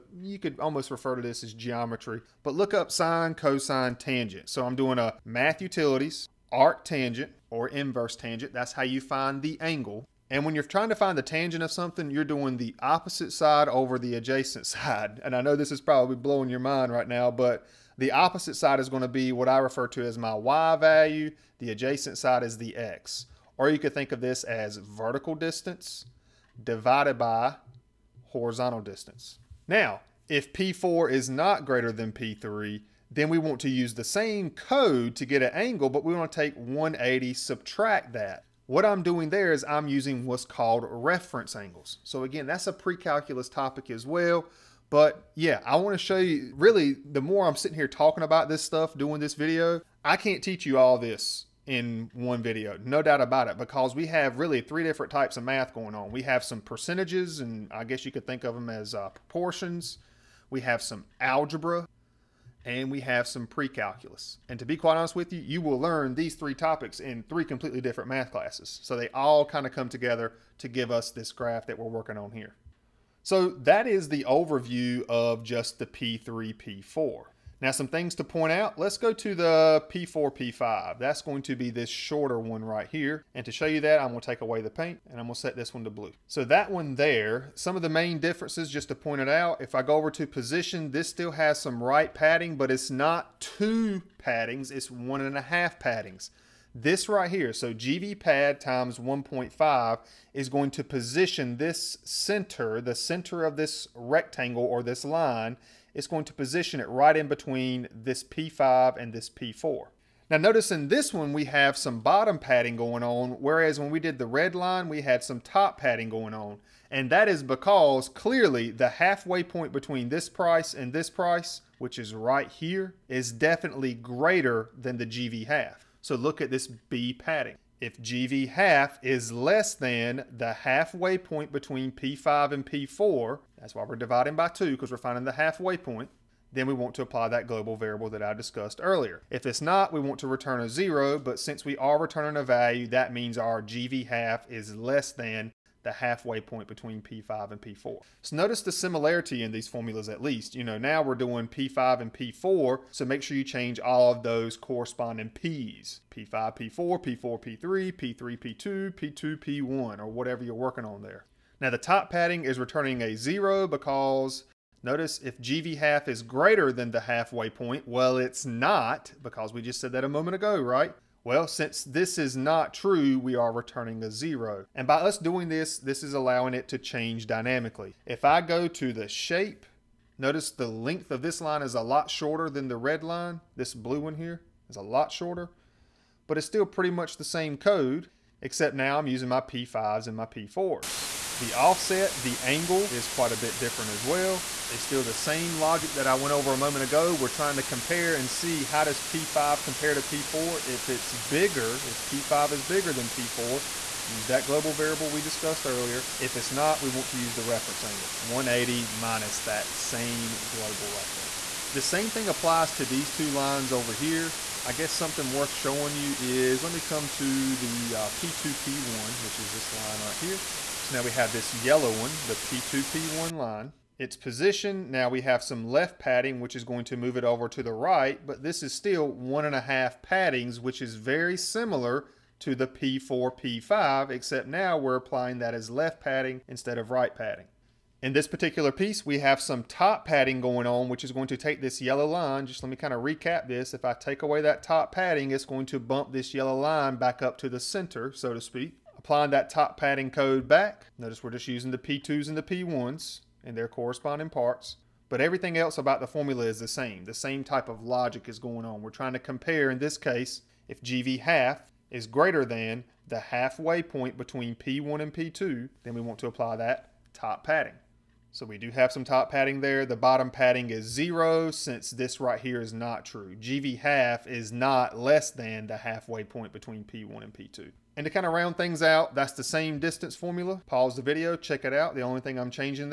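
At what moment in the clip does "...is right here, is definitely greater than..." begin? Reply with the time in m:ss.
2:01.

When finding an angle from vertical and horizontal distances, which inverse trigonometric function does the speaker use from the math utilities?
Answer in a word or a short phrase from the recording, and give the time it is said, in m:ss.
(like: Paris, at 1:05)
Arc tangent, at 0:06.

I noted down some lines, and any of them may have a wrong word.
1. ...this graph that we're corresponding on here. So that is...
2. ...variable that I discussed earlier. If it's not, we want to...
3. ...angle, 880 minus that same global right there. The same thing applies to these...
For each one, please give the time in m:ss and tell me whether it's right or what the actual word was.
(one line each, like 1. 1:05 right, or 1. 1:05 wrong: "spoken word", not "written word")
1. 1:11 wrong: "working", not "corresponding"
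2. 2:17 right
3. 3:27 wrong: "180", not "880".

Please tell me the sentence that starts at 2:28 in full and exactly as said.
So notice the similarity in these formulas at least.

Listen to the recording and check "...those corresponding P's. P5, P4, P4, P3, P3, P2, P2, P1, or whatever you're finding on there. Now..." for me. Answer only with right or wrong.
wrong.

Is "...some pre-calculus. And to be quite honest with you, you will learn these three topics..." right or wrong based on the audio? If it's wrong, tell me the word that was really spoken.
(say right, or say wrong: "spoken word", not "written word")
right.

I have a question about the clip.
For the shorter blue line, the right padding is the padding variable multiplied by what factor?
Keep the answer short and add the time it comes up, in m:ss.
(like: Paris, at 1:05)
1.5, at 1:38.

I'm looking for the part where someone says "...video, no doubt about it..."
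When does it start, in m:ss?
0:52.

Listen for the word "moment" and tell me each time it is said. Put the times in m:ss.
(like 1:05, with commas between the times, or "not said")
2:50, 3:16.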